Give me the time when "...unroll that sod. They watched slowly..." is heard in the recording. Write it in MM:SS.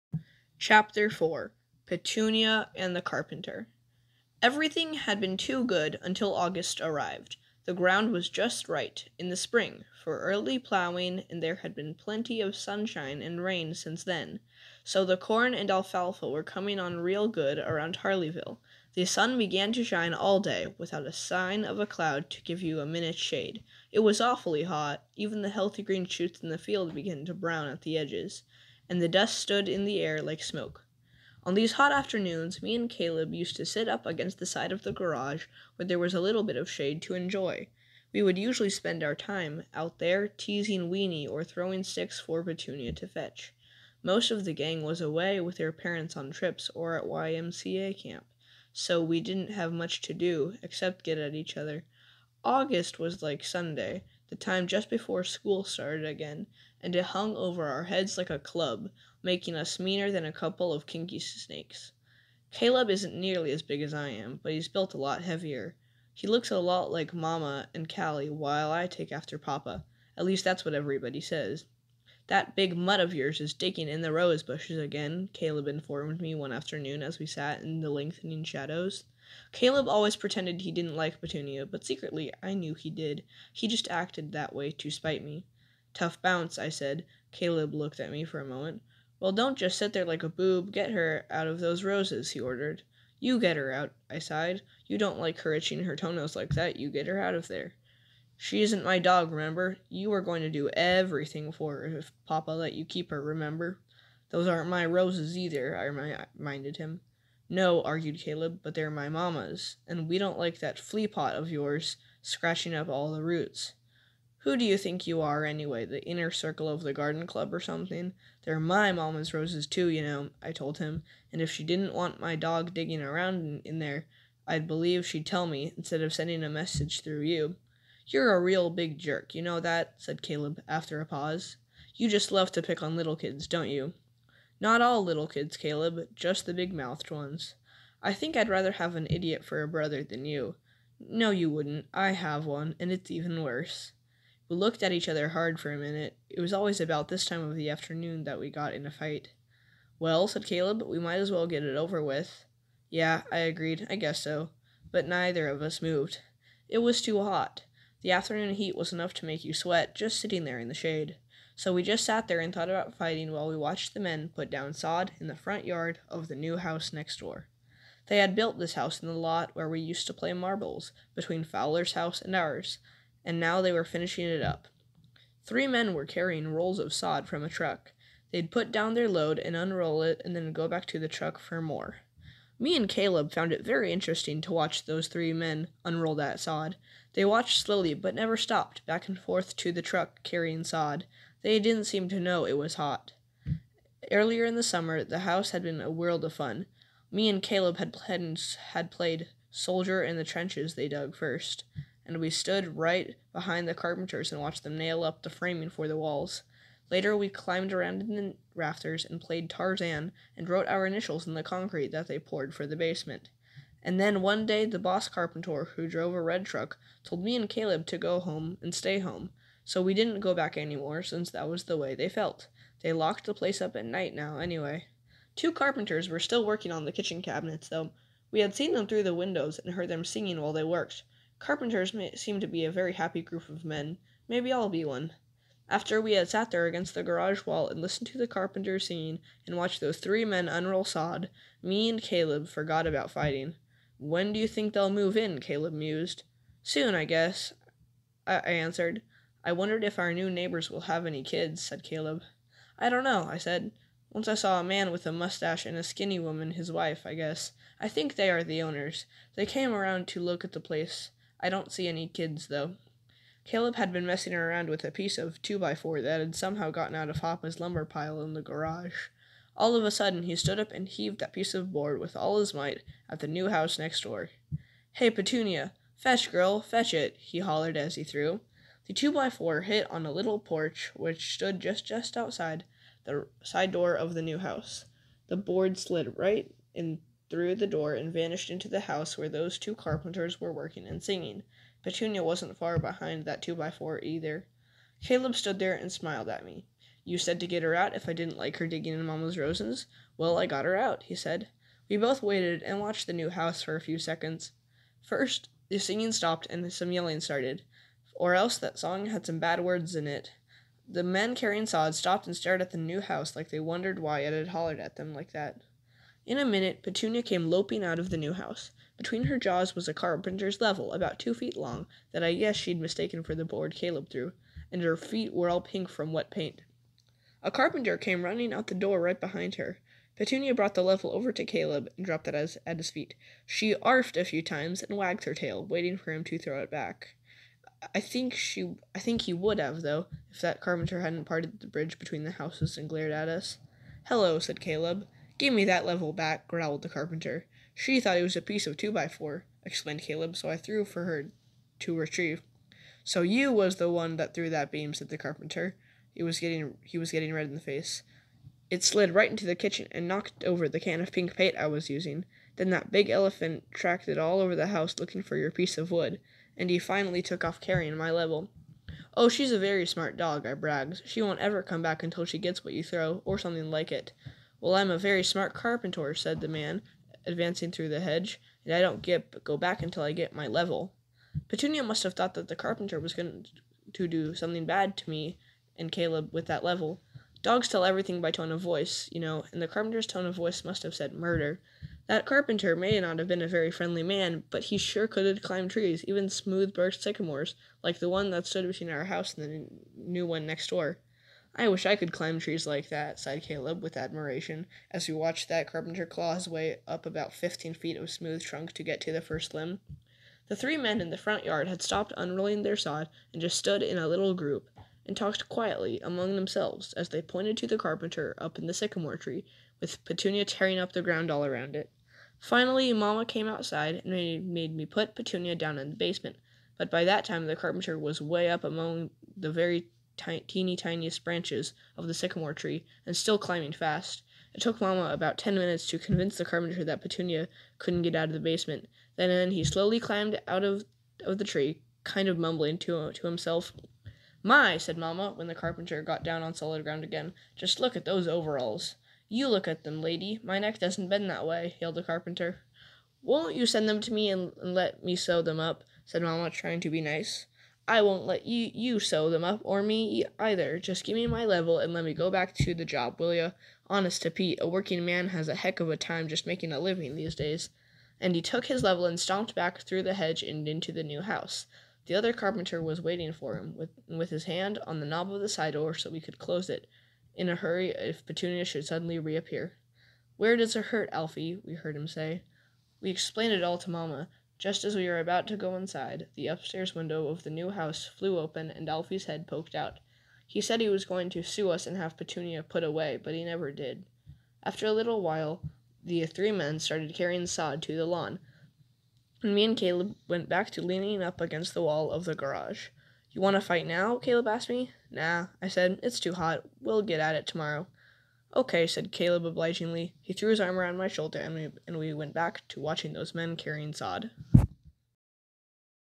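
03:05.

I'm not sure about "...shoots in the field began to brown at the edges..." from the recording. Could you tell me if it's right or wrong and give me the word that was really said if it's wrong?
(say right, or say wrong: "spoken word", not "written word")
right.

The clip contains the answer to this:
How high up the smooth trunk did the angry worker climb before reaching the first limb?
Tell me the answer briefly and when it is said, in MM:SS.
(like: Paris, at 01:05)
15 feet, at 06:47.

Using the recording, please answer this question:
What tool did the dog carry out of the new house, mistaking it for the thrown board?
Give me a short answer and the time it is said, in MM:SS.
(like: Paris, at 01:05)
carpenter's level, at 05:19.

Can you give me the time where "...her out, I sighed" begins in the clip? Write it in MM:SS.
01:33.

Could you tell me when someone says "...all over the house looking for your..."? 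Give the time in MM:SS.
06:04.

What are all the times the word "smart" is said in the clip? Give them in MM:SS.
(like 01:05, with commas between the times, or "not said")
06:09, 06:15.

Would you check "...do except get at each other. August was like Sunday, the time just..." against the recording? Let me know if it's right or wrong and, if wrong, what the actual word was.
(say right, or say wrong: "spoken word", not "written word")
right.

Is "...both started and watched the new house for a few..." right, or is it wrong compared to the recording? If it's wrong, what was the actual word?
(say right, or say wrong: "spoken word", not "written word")
wrong: "waited", not "started".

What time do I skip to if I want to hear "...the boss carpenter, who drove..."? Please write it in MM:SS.
03:34.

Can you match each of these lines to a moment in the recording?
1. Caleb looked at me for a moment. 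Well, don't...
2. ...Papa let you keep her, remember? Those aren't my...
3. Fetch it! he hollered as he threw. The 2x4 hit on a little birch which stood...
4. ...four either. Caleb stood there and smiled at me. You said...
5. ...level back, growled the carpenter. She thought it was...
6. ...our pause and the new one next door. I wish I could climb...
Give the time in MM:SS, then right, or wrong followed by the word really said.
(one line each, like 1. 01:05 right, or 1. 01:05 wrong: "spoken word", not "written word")
1. 01:27 right
2. 01:42 right
3. 04:36 wrong: "porch", not "birch"
4. 04:53 right
5. 05:45 right
6. 06:38 wrong: "house", not "pause".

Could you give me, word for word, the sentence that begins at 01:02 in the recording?
Caleb isn't nearly as big as I am, but he's built a lot heavier.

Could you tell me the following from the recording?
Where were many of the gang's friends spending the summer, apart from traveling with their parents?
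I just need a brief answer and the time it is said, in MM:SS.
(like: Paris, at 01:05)
YMCA camp, at 00:47.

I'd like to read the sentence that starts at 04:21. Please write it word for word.
I don't see any kids, though.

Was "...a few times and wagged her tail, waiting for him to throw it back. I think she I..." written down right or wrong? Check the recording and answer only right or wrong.
right.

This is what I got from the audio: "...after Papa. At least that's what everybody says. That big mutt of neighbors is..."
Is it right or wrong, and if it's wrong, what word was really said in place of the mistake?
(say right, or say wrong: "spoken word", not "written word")
wrong: "yours", not "neighbors".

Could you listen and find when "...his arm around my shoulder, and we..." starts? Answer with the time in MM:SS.
08:30.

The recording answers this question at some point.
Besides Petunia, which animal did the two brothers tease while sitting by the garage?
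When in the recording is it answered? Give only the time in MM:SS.
00:40.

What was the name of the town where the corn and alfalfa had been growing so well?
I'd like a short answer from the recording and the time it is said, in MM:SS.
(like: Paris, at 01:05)
Harleyville, at 00:17.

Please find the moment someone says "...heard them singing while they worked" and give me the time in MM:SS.
03:49.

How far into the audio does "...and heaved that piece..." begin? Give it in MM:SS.
04:30.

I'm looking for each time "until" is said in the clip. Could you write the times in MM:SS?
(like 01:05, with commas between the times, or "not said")
00:06, 06:12, 06:19.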